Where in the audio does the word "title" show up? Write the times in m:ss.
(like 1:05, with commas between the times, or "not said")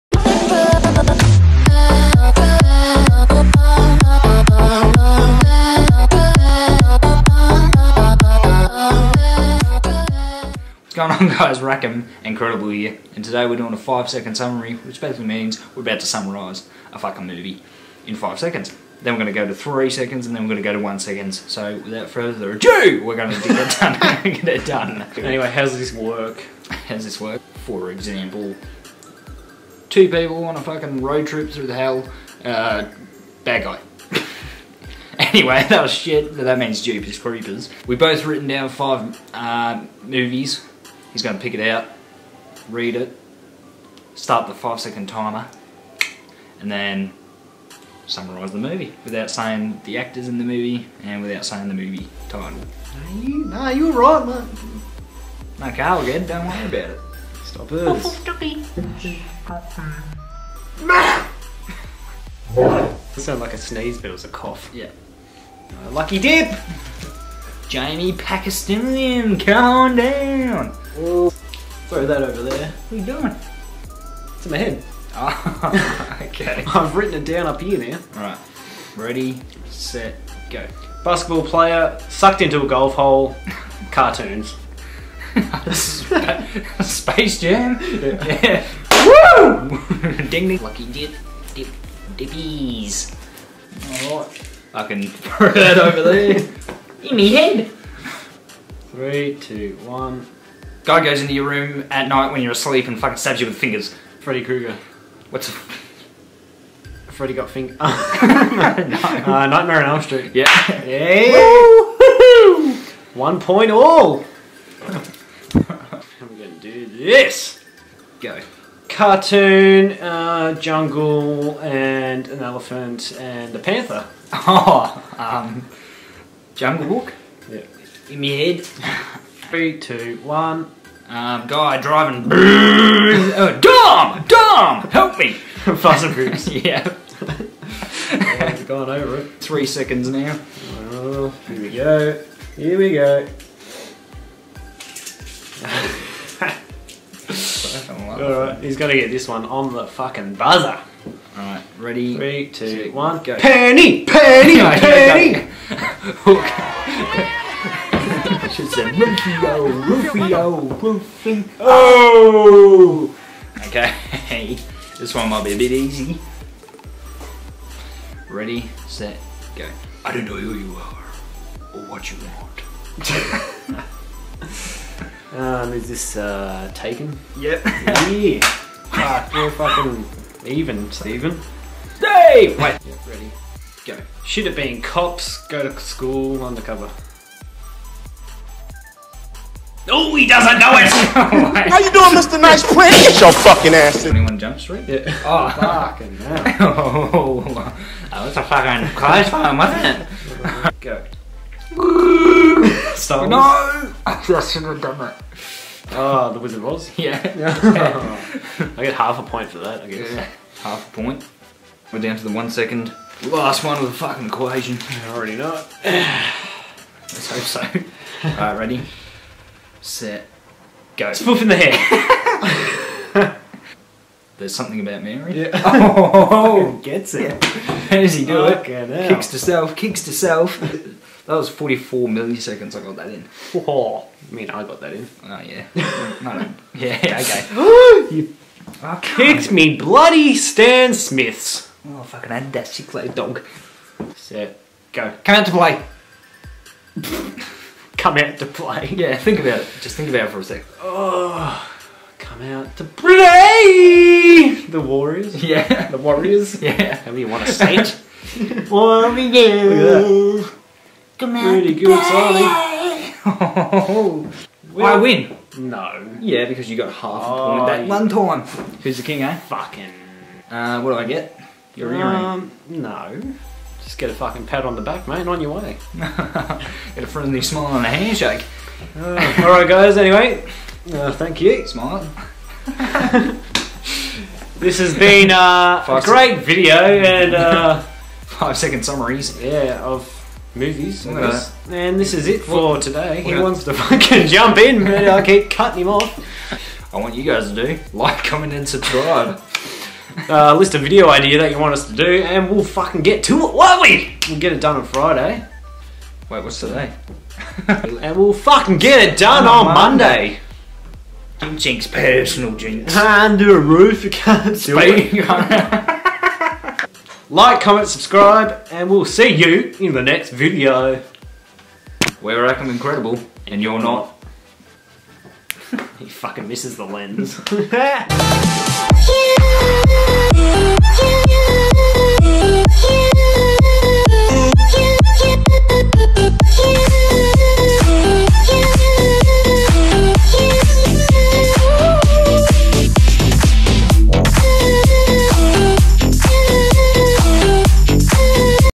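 0:52.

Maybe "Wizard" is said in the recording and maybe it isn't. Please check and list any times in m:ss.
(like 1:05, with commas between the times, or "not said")
3:26.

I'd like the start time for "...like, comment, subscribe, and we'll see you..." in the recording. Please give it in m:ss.
5:17.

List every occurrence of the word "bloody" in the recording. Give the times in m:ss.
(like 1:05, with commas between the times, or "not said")
3:59.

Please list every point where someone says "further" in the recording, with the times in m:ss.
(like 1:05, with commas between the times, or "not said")
0:22.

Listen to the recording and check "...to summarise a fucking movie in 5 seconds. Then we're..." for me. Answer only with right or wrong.
right.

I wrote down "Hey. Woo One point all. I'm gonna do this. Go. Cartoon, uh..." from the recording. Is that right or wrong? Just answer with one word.
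right.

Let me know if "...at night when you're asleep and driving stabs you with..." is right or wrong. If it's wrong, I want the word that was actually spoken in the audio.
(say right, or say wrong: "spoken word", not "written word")
wrong: "fucking", not "driving".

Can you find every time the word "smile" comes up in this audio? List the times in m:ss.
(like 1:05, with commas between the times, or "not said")
4:37, 4:41.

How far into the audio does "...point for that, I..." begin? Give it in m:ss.
3:29.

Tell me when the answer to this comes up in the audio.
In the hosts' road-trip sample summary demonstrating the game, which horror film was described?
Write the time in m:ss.
0:36.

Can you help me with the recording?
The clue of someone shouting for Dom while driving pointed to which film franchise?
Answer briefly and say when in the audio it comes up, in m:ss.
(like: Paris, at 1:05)
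Fast and Furious, at 2:15.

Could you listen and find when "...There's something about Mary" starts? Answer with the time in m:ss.
3:44.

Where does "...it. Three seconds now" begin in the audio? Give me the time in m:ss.
2:19.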